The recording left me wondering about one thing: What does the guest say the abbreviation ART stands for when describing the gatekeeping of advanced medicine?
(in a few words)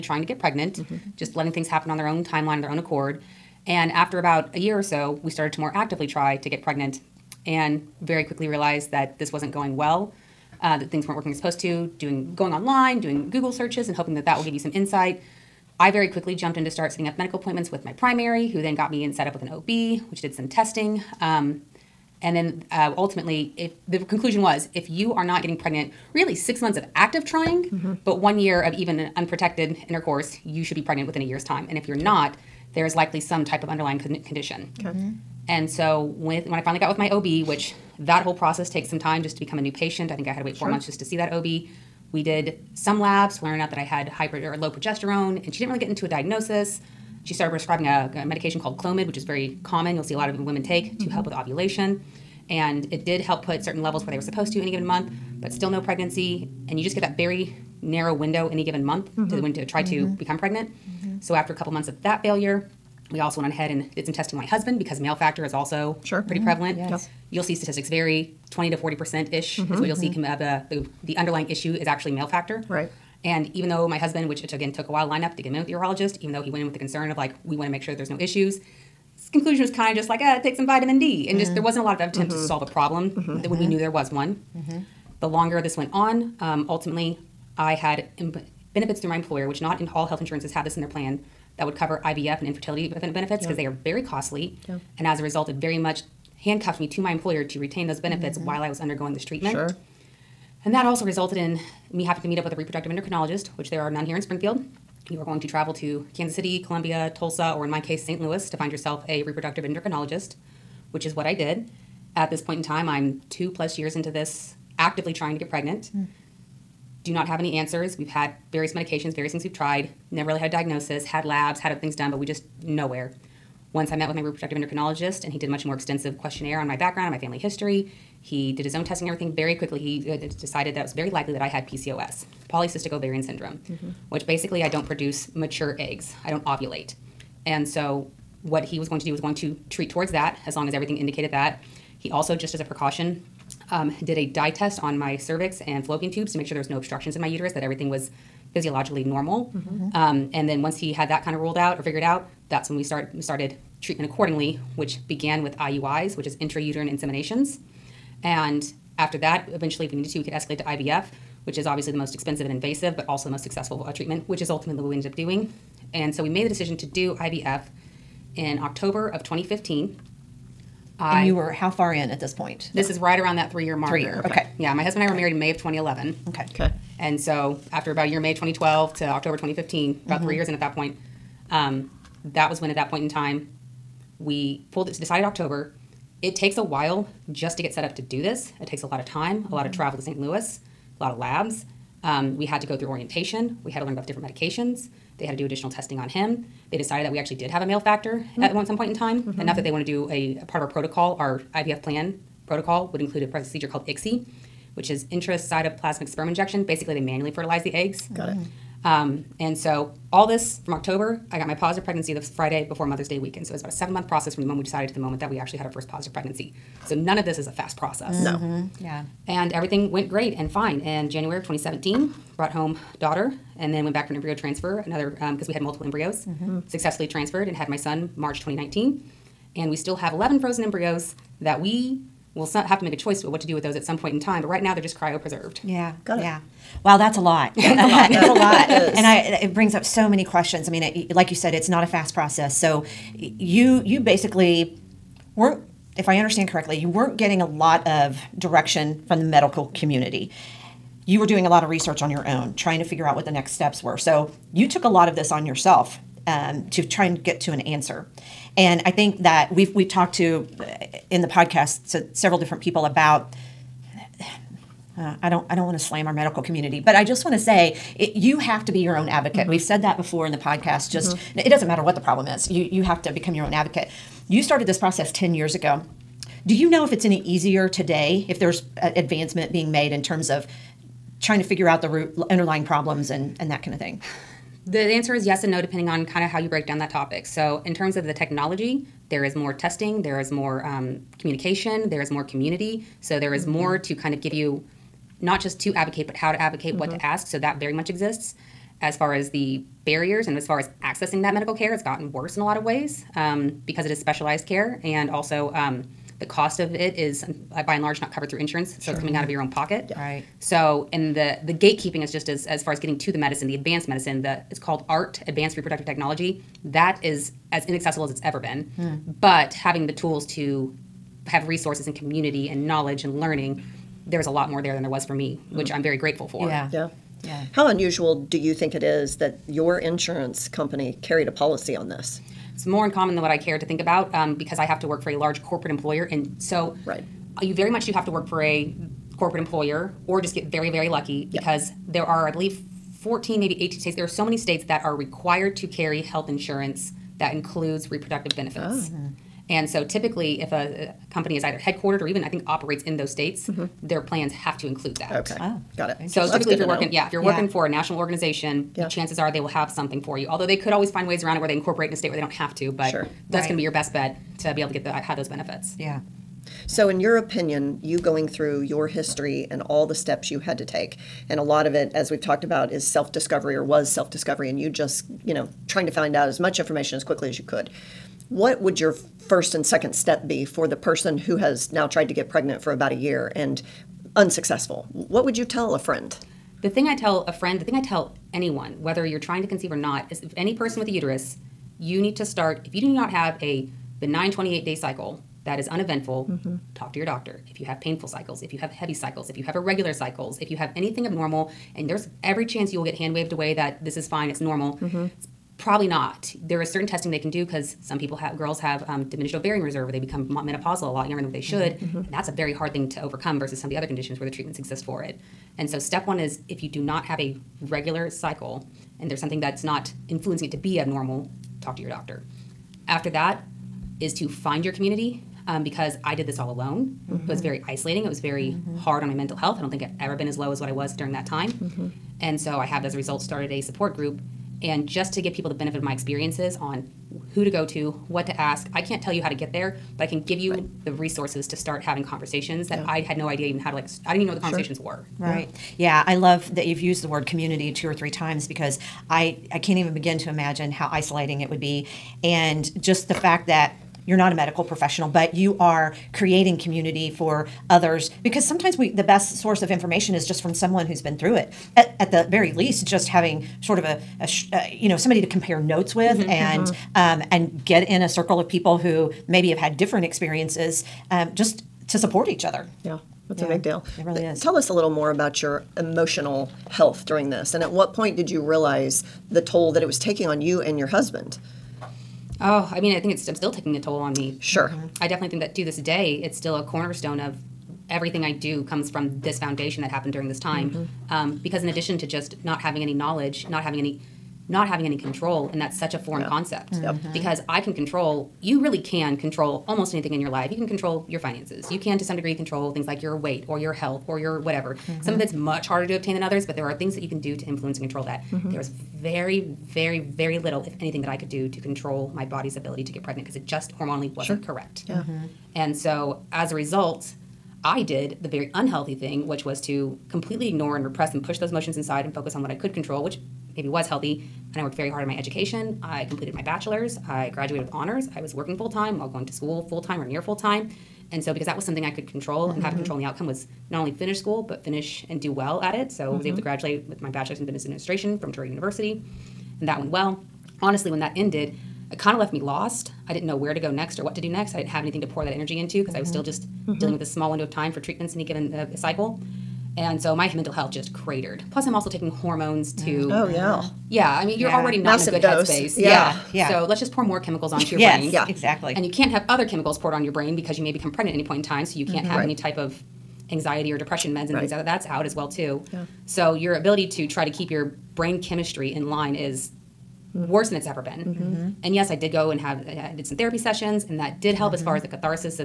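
Advanced reproductive technology.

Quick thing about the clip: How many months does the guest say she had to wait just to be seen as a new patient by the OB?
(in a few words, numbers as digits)
4.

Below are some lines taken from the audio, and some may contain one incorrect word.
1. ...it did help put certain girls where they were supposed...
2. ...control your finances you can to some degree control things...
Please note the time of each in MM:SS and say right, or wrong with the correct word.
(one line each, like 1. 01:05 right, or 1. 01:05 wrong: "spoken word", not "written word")
1. 00:52 wrong: "levels", not "girls"
2. 08:20 right.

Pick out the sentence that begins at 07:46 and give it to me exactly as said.
Um, and get in a circle of people who maybe have had different experiences, um, just to support each other.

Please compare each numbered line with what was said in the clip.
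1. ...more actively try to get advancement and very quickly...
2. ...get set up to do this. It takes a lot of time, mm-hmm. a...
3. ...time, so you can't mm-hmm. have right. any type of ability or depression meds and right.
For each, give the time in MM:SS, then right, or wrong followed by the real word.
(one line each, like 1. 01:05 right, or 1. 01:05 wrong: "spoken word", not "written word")
1. 00:05 wrong: "pregnant", not "advancement"
2. 03:07 right
3. 09:21 wrong: "anxiety", not "ability".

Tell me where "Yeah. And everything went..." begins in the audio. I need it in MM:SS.
03:38.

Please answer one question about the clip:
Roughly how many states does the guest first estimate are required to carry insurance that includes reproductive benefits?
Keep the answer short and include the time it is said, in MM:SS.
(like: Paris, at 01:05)
14, at 05:43.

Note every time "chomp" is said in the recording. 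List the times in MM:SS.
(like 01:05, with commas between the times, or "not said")
not said.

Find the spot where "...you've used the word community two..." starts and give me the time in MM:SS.
07:26.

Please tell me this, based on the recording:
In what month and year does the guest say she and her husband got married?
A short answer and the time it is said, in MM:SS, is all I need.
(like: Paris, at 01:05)
May 2011, at 02:55.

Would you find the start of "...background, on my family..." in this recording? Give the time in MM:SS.
02:06.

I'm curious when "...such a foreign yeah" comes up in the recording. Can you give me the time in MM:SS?
08:15.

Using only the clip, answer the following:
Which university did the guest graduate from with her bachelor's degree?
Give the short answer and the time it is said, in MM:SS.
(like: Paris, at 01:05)
Drury University, at 08:58.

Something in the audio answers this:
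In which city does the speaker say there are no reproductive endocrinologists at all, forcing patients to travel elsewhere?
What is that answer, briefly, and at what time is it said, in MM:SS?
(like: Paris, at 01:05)
Springfield, at 01:44.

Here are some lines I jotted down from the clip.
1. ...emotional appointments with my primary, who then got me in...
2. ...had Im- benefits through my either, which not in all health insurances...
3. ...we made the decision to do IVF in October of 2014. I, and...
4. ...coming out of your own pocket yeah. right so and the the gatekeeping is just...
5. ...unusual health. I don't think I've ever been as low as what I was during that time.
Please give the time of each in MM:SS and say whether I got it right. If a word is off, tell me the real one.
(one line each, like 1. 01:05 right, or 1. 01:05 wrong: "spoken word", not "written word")
1. 00:17 wrong: "medical", not "emotional"
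2. 01:27 wrong: "employer", not "either"
3. 02:46 wrong: "2015", not "2014"
4. 05:08 right
5. 07:09 wrong: "mental", not "unusual".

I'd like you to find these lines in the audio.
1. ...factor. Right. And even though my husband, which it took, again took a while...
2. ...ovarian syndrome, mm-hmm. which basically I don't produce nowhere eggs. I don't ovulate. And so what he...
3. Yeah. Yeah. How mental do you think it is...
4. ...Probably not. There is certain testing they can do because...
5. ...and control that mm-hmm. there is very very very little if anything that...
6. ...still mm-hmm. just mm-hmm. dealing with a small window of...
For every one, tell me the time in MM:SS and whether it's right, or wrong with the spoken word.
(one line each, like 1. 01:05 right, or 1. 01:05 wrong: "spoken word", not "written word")
1. 01:12 right
2. 02:12 wrong: "mature", not "nowhere"
3. 05:26 wrong: "unusual", not "mental"
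4. 06:45 right
5. 08:27 right
6. 09:06 right.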